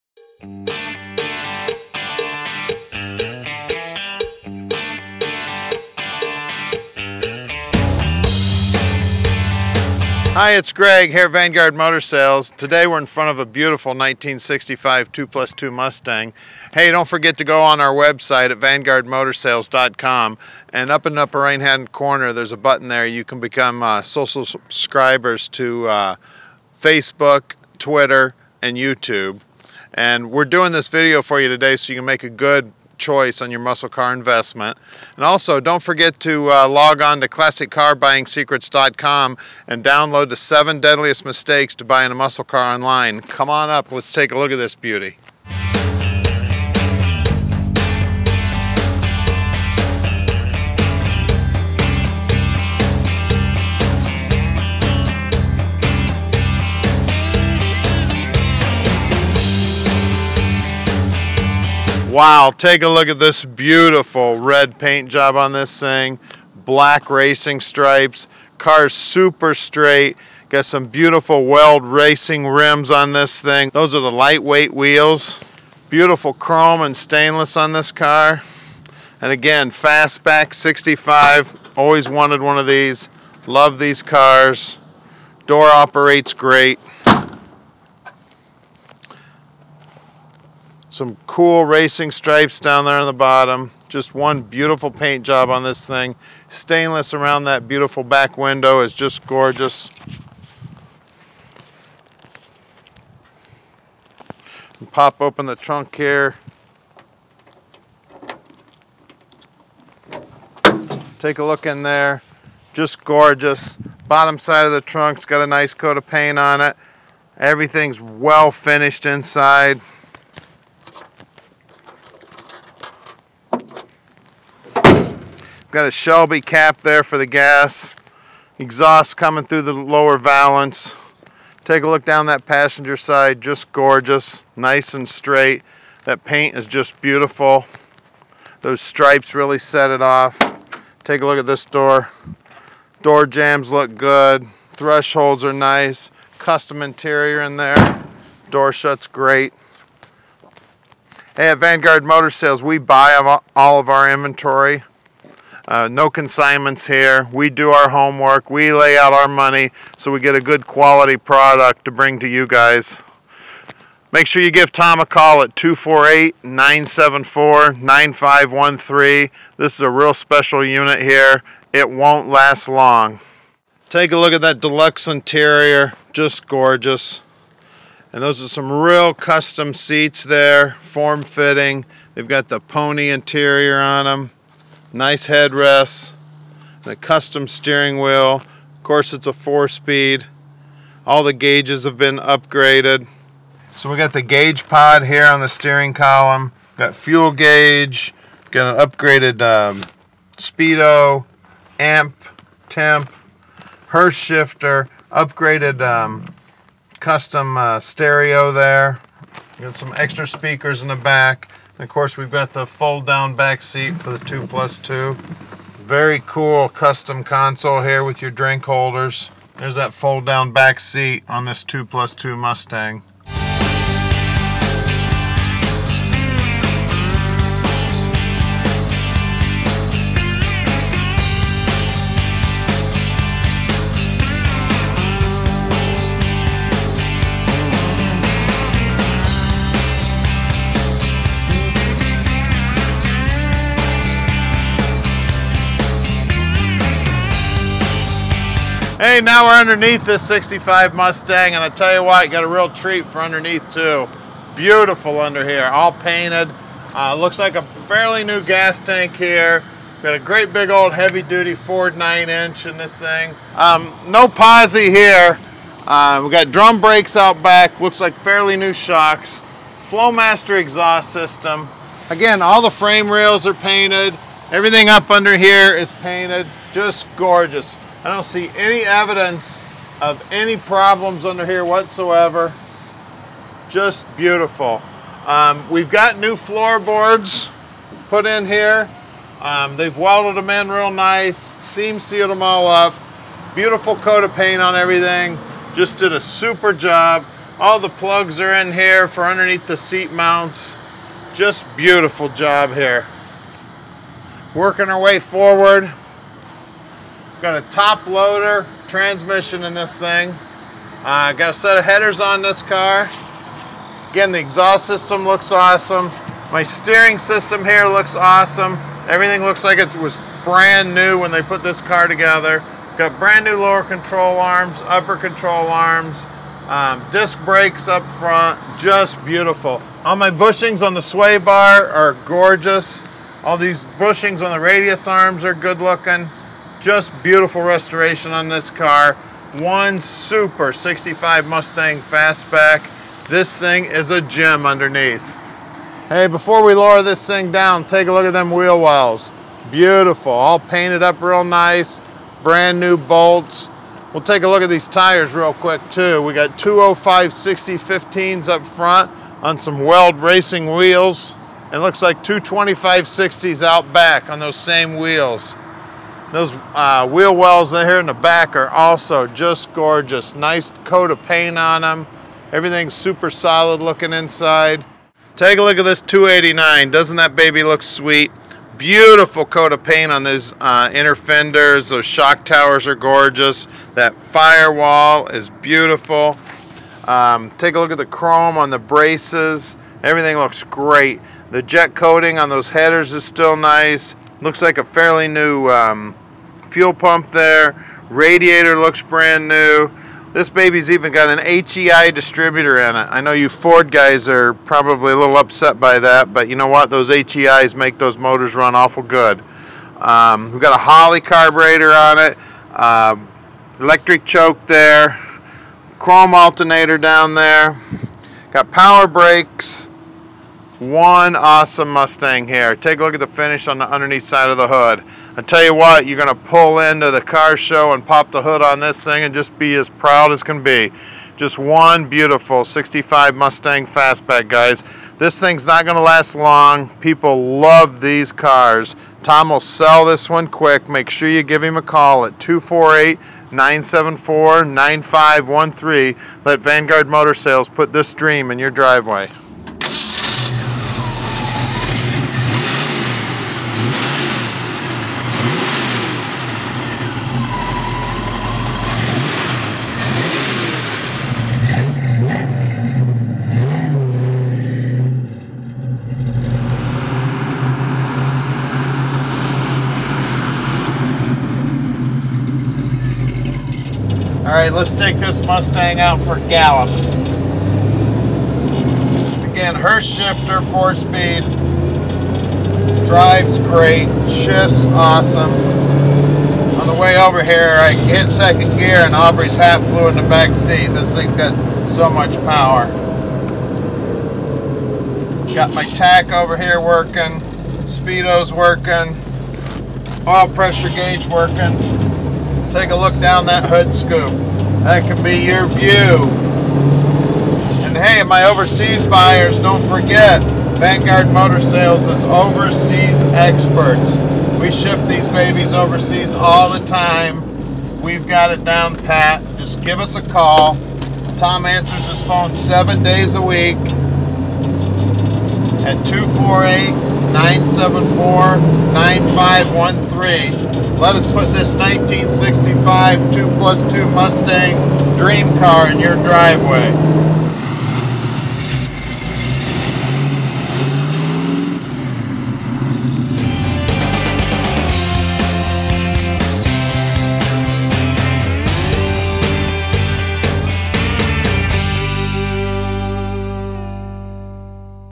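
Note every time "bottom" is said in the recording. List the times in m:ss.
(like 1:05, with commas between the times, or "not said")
1:33, 1:54.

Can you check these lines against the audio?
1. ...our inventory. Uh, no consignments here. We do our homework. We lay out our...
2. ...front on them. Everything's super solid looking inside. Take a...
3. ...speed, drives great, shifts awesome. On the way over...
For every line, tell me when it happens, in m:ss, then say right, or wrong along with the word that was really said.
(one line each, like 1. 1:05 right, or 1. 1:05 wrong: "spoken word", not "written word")
1. 2:33 right
2. 6:11 wrong: "paint", not "front"
3. 8:00 right.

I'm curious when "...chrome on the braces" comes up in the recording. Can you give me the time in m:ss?
6:28.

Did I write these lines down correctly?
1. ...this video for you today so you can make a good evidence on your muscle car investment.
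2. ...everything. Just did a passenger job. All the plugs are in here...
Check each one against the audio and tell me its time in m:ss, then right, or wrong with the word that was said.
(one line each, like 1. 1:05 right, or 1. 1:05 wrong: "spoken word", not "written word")
1. 0:30 wrong: "choice", not "evidence"
2. 4:54 wrong: "super", not "passenger".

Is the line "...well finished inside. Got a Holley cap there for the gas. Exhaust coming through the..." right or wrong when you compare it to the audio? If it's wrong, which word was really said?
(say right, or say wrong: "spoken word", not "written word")
wrong: "Shelby", not "Holley".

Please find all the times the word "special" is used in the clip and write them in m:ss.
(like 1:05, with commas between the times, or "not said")
2:50.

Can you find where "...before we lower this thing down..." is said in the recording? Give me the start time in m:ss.
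5:46.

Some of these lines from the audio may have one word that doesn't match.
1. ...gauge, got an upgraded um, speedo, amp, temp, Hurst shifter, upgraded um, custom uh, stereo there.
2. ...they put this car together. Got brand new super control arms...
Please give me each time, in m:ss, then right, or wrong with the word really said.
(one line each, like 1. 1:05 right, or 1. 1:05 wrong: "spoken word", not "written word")
1. 3:17 right
2. 5:21 wrong: "lower", not "super".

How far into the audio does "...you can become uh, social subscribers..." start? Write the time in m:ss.
0:23.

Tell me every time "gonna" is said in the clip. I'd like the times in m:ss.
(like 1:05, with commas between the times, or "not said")
7:06, 7:15.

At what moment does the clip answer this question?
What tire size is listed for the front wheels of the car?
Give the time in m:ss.
5:56.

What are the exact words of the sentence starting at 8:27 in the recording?
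And hey, my overseas buyers, don't forget, Vanguard Motor Sales is overseas experts.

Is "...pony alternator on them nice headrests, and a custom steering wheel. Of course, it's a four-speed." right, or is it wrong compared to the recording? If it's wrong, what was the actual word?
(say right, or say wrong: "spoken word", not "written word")
wrong: "interior", not "alternator".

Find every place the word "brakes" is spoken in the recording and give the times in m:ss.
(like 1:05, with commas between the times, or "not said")
4:26, 5:27, 6:59.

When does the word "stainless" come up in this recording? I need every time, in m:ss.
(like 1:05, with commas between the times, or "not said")
1:16, 1:36.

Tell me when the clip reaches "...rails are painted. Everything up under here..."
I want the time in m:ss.
4:33.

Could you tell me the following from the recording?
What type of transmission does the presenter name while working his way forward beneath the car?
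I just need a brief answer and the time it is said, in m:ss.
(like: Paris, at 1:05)
Top loader, at 5:07.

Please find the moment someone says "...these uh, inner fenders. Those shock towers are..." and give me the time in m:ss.
6:20.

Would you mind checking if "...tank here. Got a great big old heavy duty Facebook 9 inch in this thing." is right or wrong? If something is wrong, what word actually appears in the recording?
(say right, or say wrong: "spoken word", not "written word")
wrong: "Ford", not "Facebook".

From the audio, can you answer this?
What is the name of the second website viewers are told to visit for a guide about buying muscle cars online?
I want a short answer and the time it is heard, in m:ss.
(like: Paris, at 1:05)
classiccarbuyingsecrets.com, at 0:37.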